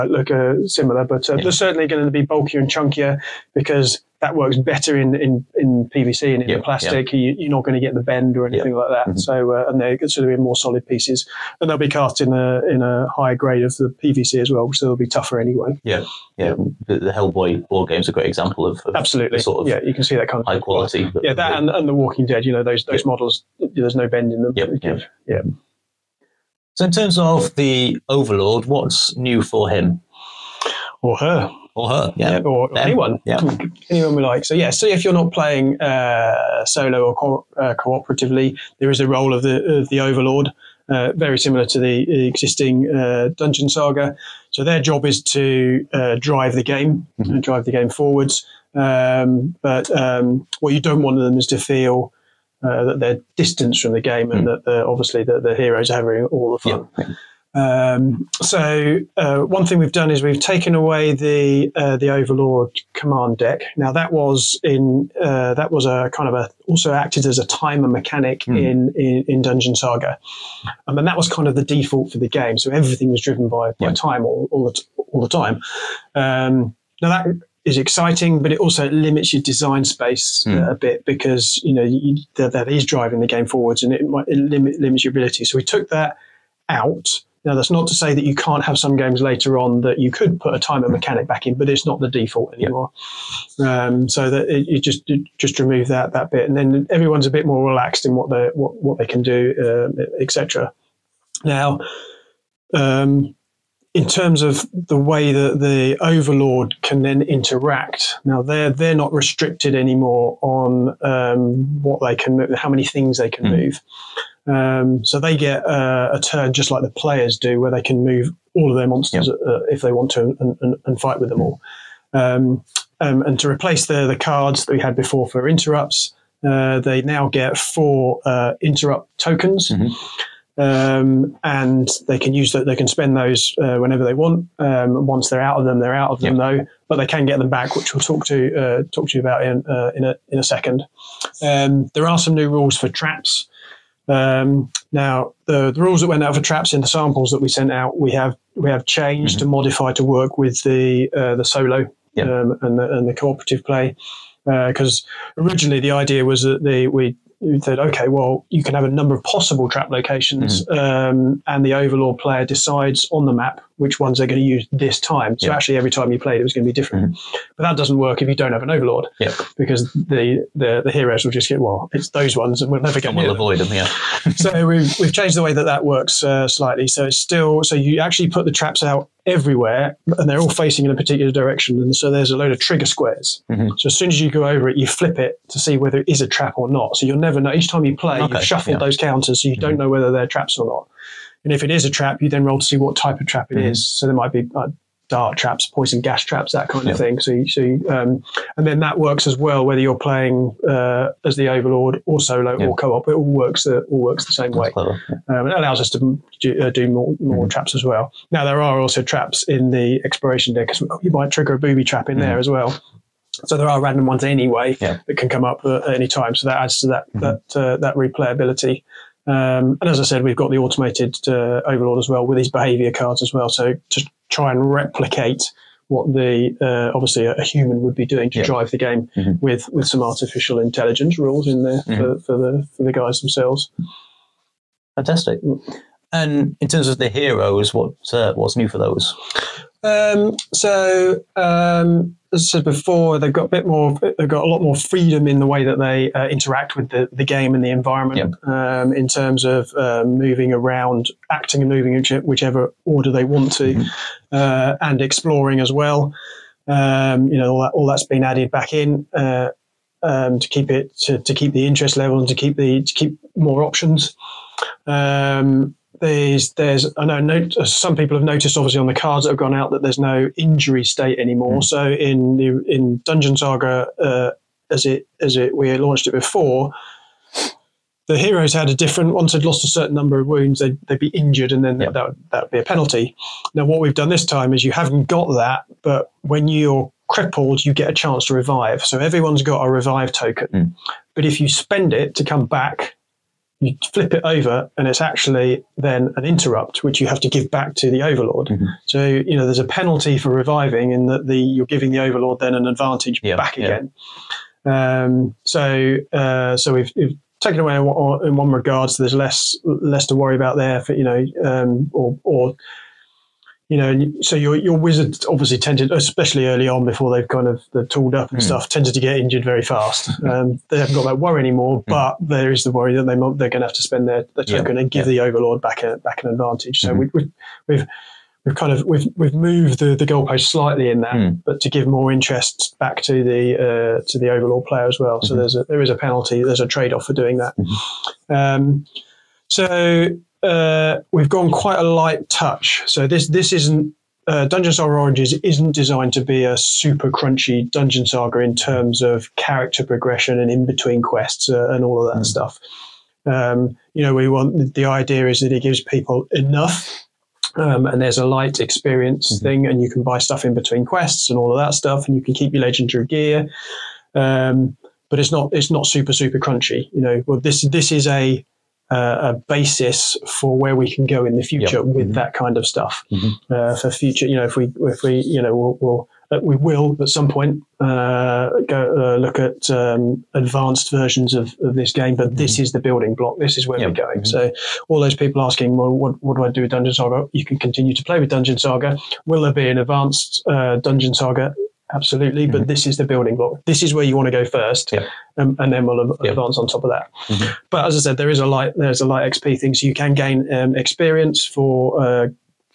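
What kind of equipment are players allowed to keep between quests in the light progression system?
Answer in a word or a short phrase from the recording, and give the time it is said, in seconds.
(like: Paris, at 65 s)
Legendary gear, at 362 s.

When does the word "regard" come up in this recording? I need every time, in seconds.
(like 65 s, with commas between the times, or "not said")
308 s.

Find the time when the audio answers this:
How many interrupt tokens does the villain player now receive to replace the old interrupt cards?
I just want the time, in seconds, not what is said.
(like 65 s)
127 s.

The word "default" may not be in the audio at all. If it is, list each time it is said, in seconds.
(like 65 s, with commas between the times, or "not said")
71 s, 92 s.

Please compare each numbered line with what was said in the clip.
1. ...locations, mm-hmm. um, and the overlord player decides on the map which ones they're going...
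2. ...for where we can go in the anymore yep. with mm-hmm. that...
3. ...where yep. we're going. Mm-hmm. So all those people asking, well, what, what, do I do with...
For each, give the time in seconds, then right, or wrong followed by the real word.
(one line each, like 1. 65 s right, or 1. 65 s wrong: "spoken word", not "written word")
1. 159 s right
2. 370 s wrong: "future", not "anymore"
3. 383 s right.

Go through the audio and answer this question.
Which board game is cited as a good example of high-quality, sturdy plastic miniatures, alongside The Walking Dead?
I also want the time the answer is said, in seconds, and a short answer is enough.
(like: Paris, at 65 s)
Hellboy, at 17 s.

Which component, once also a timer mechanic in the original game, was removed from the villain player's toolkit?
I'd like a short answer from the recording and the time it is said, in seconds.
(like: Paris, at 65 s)
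Overlord command deck, at 62 s.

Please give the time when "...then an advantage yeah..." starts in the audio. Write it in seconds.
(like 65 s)
302 s.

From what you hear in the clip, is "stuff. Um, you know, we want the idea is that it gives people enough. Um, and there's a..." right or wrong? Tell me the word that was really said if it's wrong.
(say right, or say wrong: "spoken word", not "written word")
right.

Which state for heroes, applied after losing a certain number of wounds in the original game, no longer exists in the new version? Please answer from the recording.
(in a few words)
Injury state.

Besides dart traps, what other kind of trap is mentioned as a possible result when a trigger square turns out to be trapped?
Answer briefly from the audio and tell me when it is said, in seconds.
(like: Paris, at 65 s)
Poison gas traps, at 195 s.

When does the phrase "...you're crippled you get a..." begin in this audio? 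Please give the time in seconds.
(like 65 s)
286 s.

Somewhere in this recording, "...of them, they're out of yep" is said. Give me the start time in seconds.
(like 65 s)
135 s.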